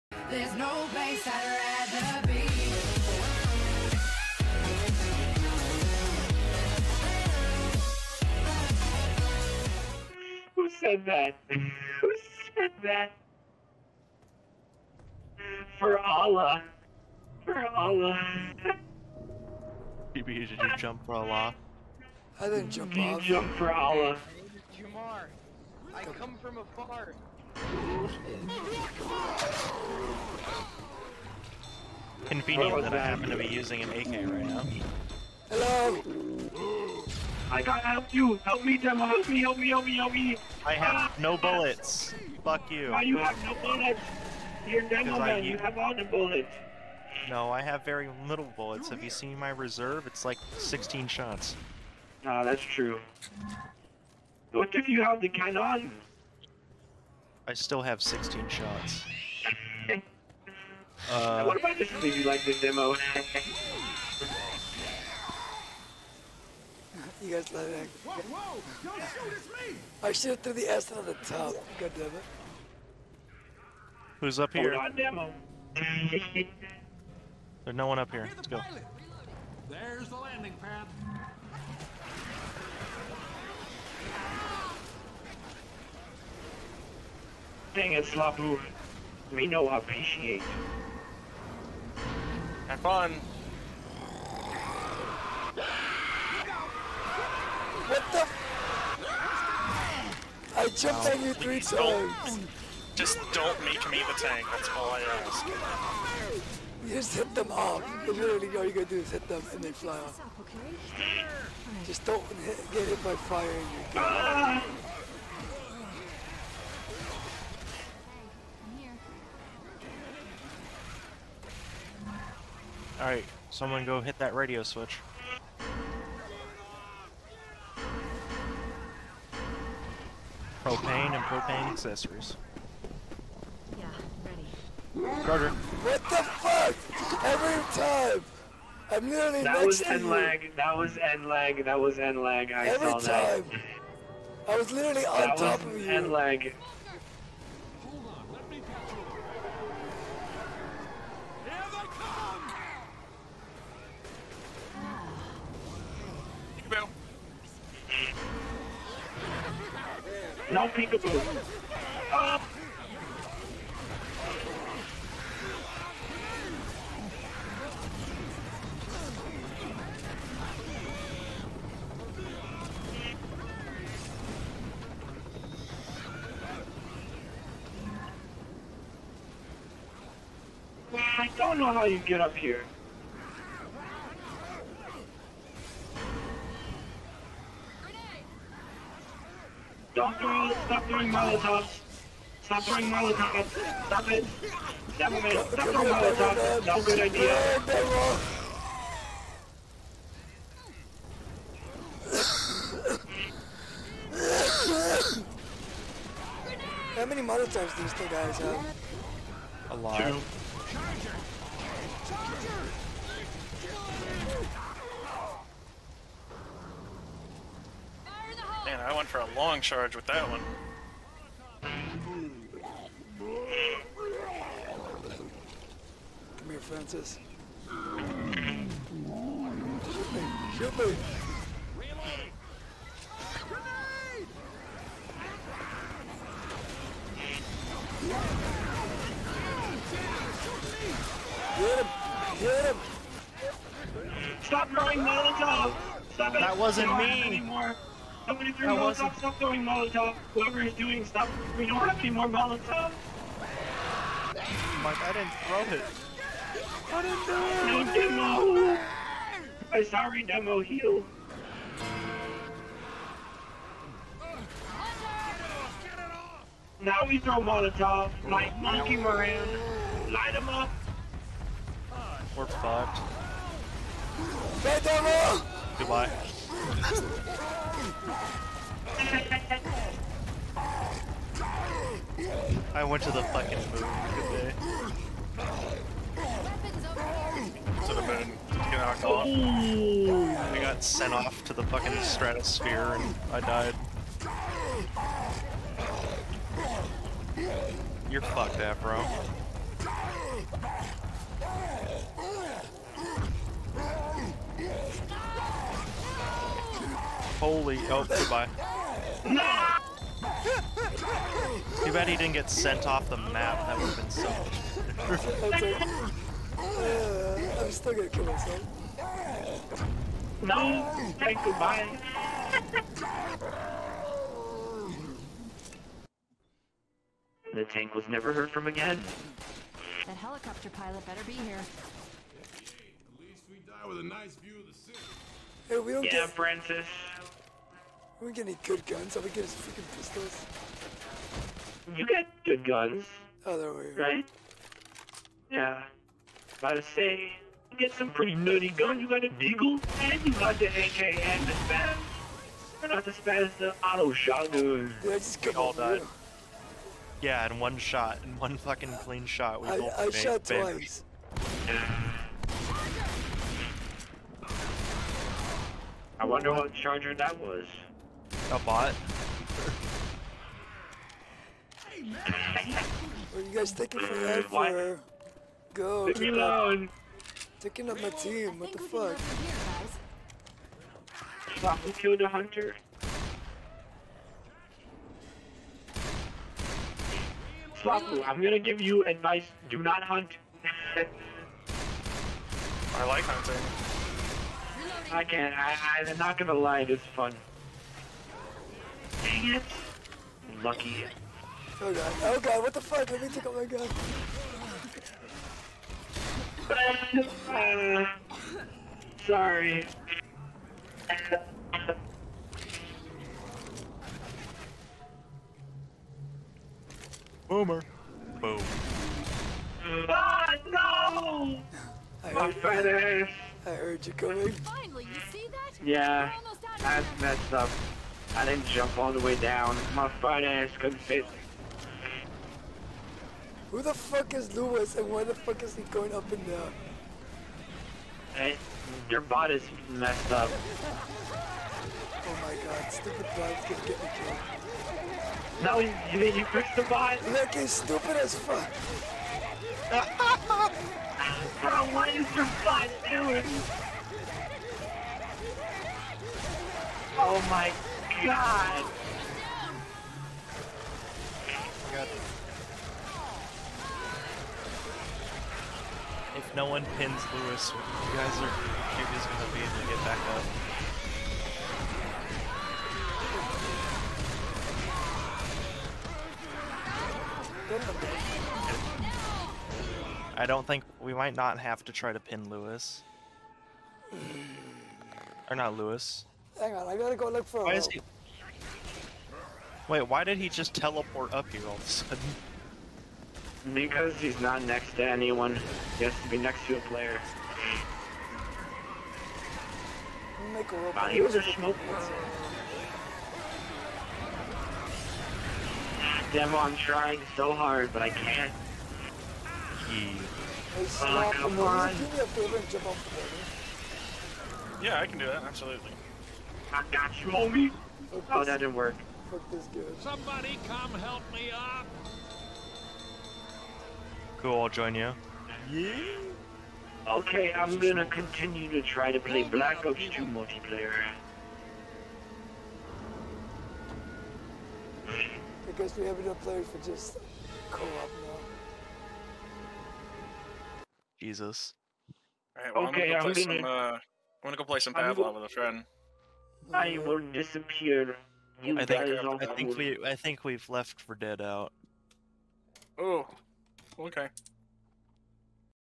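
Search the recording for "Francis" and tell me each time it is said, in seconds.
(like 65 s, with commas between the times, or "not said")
226 s, 336 s.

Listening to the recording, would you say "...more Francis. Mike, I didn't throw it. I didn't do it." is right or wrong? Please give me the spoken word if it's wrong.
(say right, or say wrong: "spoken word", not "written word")
wrong: "Molotov", not "Francis".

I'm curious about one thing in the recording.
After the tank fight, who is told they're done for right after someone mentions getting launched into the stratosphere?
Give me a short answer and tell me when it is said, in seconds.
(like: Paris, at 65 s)
Afro, at 298 s.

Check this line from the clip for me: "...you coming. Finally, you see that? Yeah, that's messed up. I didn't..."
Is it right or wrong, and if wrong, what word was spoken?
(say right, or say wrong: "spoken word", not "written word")
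right.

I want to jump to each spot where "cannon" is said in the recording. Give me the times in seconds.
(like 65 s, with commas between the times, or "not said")
55 s.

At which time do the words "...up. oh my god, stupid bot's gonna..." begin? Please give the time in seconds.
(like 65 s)
440 s.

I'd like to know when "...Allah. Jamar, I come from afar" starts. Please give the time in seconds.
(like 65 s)
23 s.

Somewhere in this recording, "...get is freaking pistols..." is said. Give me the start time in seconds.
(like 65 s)
339 s.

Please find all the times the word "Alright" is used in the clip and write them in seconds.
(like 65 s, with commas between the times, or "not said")
123 s, 542 s.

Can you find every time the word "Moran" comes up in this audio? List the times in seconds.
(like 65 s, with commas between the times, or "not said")
268 s.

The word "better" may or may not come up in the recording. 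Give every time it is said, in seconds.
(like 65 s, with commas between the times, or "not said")
315 s, 331 s.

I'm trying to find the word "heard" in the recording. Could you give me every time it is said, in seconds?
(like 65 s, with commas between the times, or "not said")
328 s, 423 s.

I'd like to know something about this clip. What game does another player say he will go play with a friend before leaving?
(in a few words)
Pavlov.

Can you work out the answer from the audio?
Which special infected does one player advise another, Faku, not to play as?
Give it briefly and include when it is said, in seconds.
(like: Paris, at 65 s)
Hunter, at 390 s.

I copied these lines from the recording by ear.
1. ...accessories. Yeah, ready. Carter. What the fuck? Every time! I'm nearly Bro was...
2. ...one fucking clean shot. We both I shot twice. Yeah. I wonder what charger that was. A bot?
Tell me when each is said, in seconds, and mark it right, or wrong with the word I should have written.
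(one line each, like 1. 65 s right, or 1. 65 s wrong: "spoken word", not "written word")
1. 131 s wrong: "That", not "Bro"
2. 358 s right.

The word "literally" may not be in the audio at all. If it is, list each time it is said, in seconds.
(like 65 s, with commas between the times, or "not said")
108 s, 144 s.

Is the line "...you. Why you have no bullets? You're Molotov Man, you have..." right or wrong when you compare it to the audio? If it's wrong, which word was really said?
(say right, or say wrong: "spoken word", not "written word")
wrong: "Demo", not "Molotov".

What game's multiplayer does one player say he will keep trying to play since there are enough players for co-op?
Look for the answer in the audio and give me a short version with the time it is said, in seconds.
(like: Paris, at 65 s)
Black Ops 2, at 529 s.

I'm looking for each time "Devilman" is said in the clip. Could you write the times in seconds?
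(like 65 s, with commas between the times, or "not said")
194 s.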